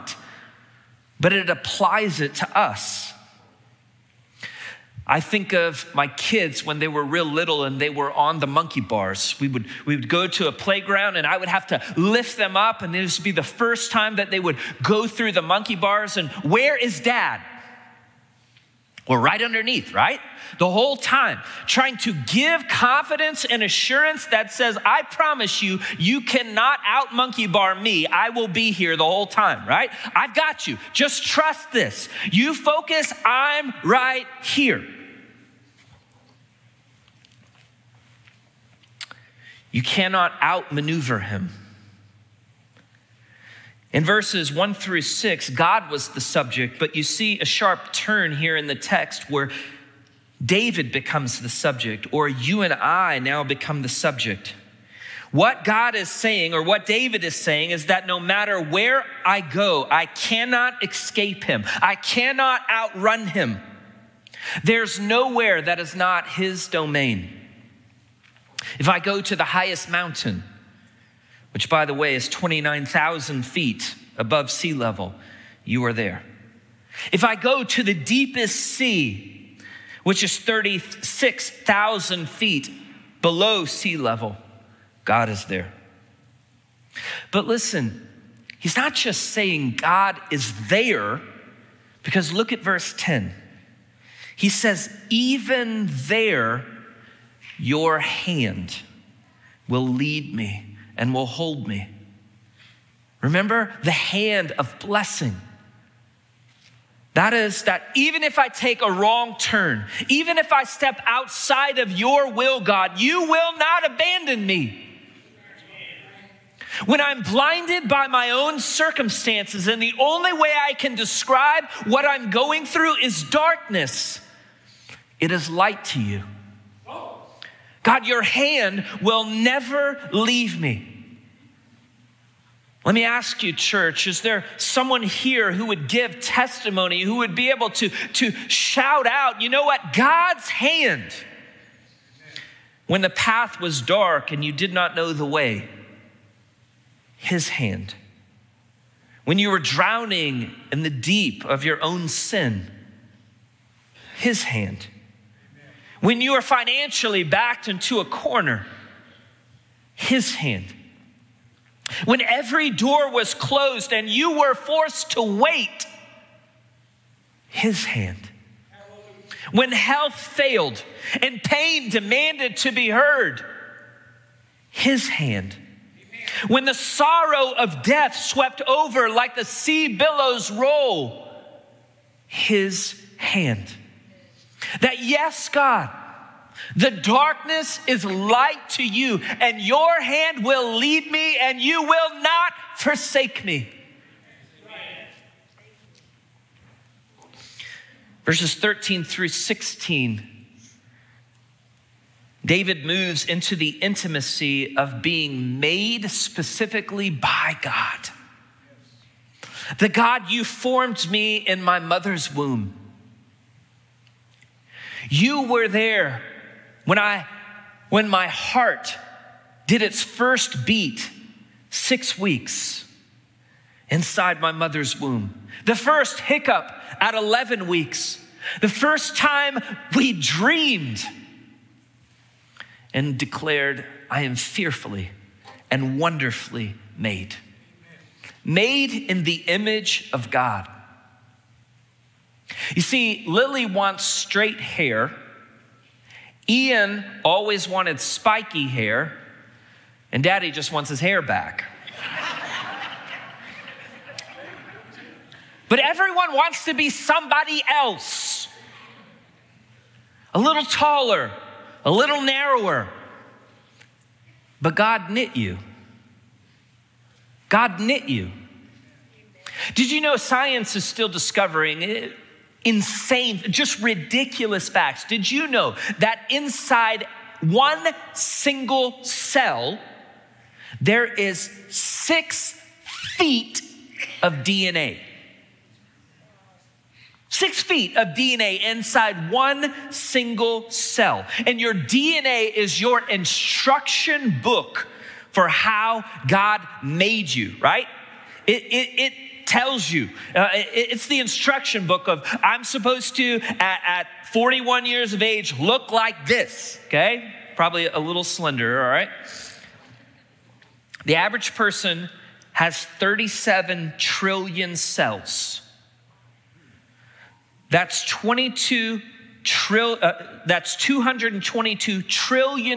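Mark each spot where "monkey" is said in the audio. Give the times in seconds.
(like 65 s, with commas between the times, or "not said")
8 s, 15 s, 27 s.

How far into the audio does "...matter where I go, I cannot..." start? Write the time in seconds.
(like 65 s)
58 s.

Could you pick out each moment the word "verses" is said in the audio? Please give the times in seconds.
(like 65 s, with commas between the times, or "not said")
44 s, 92 s, 198 s.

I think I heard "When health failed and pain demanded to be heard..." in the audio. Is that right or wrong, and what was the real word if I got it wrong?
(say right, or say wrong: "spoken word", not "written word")
right.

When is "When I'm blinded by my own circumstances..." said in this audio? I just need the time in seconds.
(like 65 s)
116 s.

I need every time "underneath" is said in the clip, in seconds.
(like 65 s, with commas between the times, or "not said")
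19 s.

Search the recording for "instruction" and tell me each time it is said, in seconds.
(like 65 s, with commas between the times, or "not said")
293 s, 301 s.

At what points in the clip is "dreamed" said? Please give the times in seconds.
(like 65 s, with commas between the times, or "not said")
230 s.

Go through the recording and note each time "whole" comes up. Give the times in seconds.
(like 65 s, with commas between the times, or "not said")
20 s, 29 s.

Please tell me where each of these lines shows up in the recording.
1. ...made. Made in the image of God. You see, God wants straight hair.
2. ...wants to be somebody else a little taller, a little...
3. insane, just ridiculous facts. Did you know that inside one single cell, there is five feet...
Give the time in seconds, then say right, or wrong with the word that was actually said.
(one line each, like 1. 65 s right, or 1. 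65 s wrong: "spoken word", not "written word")
1. 236 s wrong: "Lily", not "God"
2. 256 s right
3. 272 s wrong: "six", not "five".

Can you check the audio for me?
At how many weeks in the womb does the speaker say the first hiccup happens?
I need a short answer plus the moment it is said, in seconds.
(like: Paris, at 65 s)
11 weeks, at 227 s.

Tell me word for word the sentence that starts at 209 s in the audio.
The God you formed me in my mother's womb.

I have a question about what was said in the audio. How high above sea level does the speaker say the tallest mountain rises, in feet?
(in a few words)
29,000 feet.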